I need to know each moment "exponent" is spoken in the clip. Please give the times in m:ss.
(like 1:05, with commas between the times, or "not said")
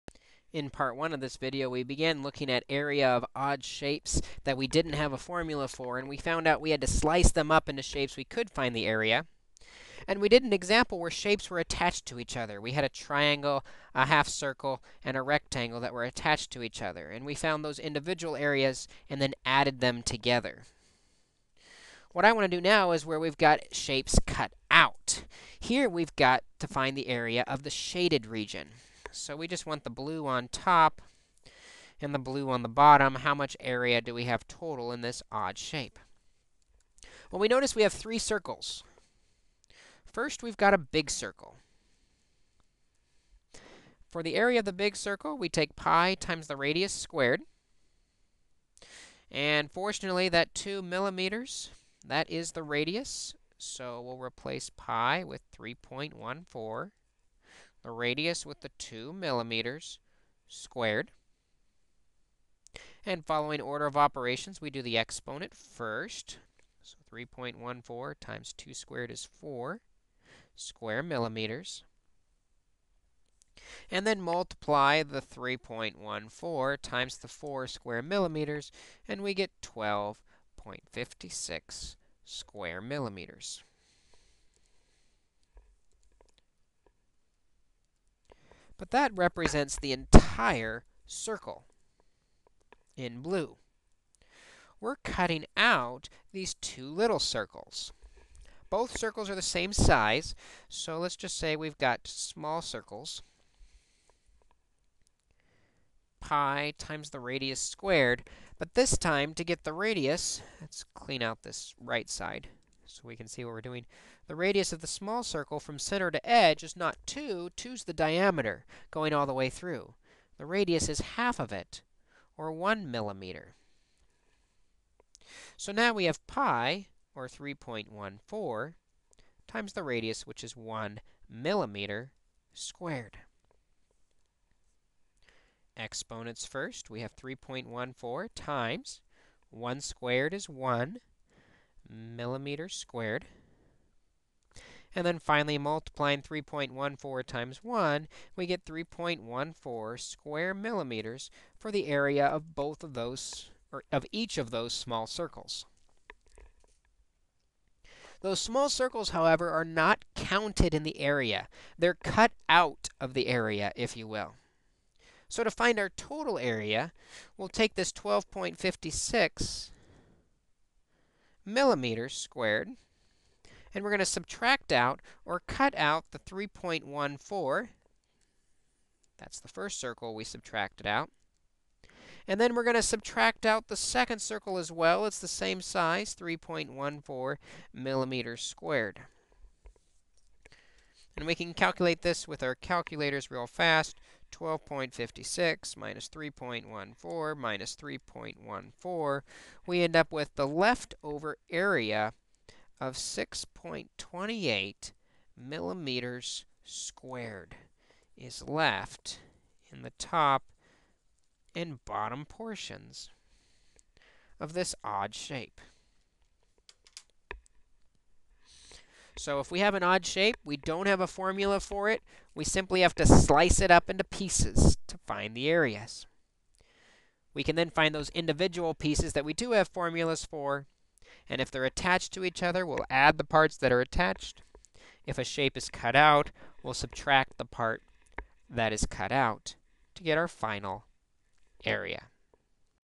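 1:04, 2:15.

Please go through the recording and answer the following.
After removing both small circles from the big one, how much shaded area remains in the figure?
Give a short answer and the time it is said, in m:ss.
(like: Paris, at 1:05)
6.28 square millimeters, at 3:22.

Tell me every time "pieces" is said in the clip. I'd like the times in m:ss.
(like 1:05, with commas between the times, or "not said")
3:44, 3:48.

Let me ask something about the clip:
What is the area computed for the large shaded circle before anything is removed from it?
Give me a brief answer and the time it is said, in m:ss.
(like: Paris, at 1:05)
12.56 square millimeters, at 1:19.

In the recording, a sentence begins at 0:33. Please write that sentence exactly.
How much area do we have total in this odd shape?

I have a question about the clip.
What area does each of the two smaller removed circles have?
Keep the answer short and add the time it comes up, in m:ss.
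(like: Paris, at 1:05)
3.14 square millimeters, at 2:28.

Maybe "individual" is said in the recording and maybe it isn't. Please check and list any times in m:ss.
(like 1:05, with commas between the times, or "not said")
0:17, 3:48.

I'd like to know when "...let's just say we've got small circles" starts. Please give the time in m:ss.
1:40.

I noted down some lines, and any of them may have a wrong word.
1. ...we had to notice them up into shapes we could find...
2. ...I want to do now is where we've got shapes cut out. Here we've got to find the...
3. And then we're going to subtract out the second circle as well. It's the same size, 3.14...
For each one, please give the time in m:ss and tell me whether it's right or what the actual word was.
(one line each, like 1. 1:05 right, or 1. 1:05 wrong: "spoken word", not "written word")
1. 0:06 wrong: "slice", not "notice"
2. 0:22 right
3. 3:02 right.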